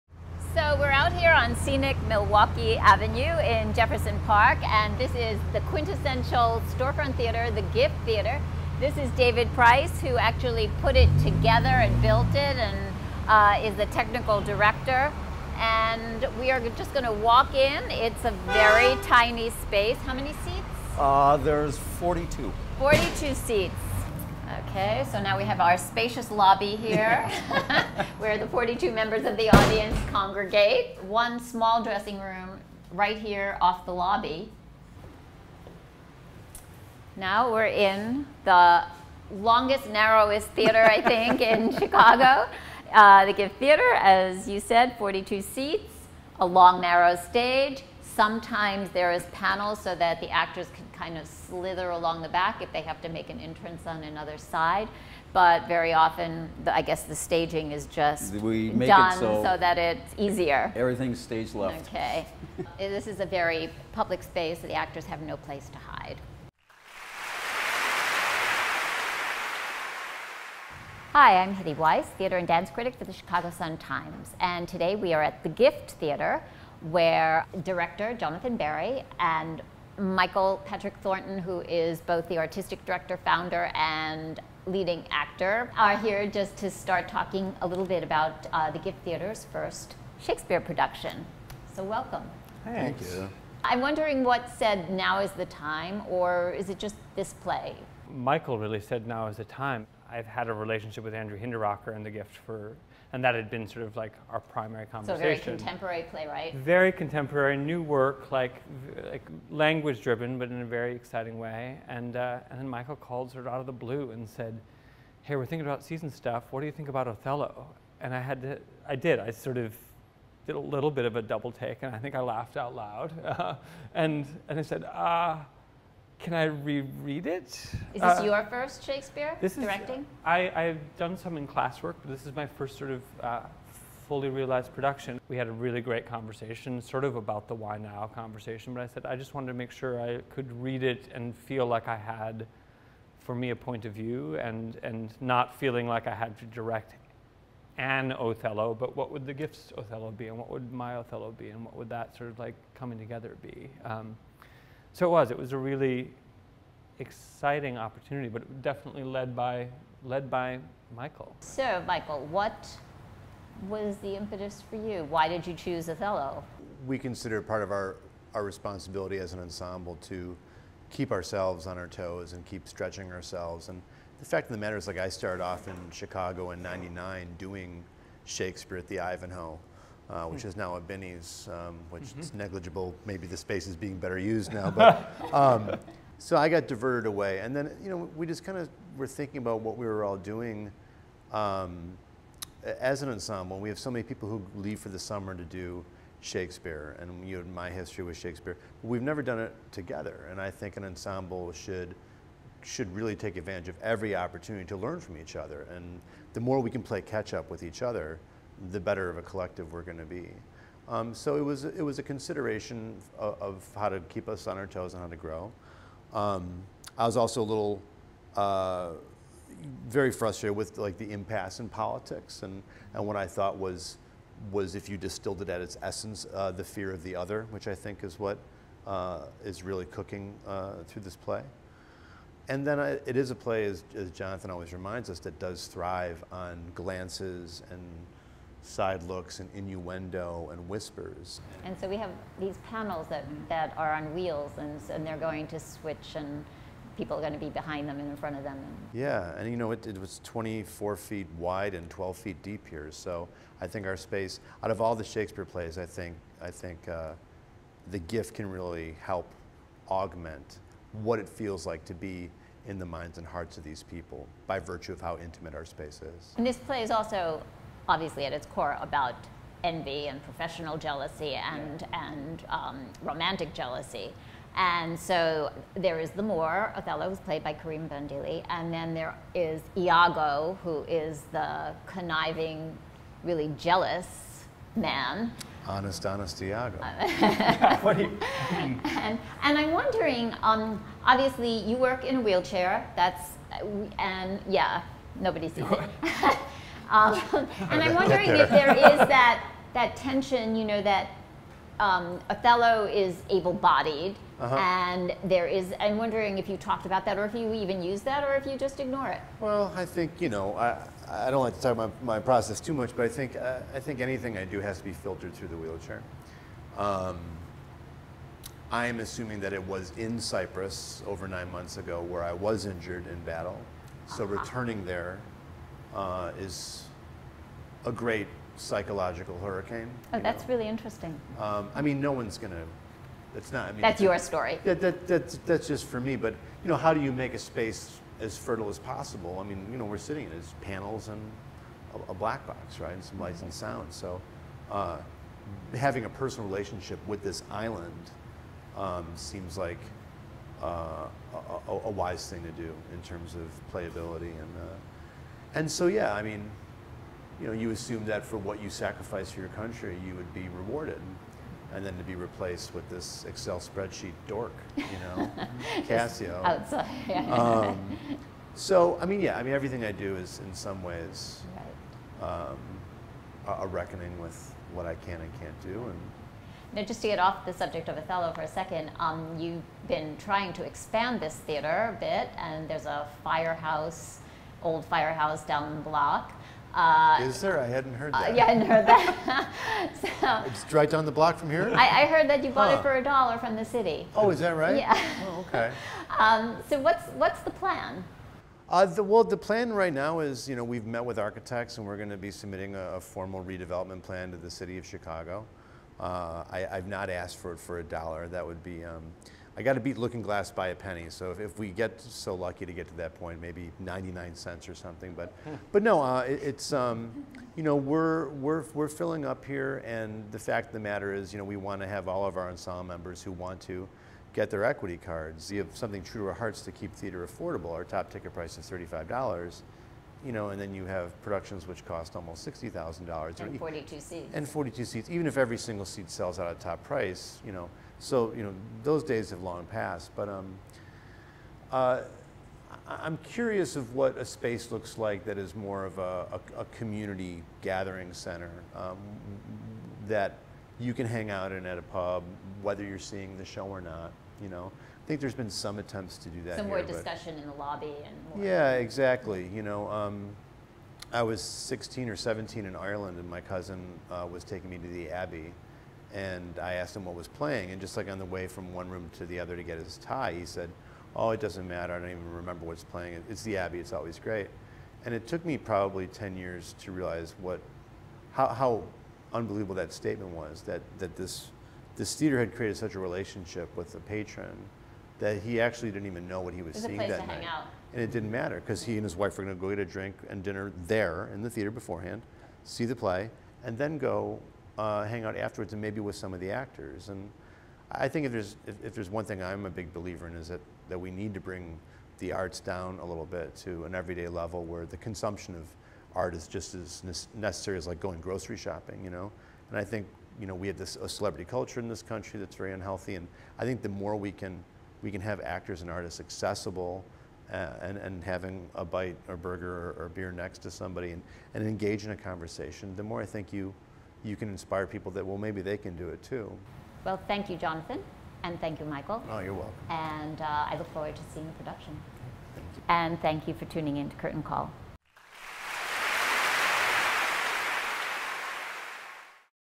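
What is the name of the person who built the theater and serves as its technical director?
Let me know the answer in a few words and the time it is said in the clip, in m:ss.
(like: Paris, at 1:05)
David Price, at 0:09.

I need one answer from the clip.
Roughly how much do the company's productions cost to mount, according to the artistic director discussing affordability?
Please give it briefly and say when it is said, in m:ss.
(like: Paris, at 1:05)
$60,000, at 7:12.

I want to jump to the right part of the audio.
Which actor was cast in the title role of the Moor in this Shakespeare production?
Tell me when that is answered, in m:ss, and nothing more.
4:37.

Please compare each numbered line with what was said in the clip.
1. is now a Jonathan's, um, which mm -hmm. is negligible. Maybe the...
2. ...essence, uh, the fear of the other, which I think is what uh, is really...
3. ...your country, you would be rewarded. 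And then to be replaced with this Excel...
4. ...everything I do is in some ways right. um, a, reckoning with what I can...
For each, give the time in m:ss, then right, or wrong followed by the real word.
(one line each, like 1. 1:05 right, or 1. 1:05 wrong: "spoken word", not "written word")
1. 3:00 wrong: "Binny", not "Jonathan"
2. 3:45 right
3. 5:59 right
4. 6:09 right.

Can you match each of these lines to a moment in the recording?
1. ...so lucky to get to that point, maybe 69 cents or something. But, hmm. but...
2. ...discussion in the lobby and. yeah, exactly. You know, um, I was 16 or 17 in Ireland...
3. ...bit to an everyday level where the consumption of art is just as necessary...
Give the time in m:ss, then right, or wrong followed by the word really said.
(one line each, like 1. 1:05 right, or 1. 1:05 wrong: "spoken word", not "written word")
1. 6:51 wrong: "99", not "69"
2. 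7:36 right
3. 8:23 right.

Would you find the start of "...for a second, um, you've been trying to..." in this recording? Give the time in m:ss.
6:18.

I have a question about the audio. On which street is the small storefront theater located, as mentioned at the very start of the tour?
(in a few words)
Milwaukee Avenue.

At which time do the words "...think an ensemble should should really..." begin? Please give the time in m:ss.
3:20.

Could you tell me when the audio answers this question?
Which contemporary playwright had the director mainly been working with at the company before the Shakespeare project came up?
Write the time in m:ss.
1:41.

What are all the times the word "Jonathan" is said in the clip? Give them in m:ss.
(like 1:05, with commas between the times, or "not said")
1:18, 3:54, 8:47.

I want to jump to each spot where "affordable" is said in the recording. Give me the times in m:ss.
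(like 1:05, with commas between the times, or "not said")
7:07.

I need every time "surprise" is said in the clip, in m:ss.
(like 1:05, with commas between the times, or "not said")
not said.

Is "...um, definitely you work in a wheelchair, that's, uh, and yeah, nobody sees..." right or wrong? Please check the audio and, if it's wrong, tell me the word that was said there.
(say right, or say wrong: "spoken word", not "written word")
wrong: "obviously", not "definitely".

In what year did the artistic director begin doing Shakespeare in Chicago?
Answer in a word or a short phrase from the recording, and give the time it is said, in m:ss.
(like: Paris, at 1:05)
1999, at 2:56.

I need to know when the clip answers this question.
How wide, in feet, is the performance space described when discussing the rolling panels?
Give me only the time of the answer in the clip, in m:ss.
4:10.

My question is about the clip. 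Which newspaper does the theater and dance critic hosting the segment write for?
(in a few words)
Chicago Sun-Times.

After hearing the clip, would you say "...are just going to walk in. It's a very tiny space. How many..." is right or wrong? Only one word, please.
right.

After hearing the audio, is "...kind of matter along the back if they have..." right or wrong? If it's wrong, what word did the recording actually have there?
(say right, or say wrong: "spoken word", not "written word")
wrong: "slither", not "matter".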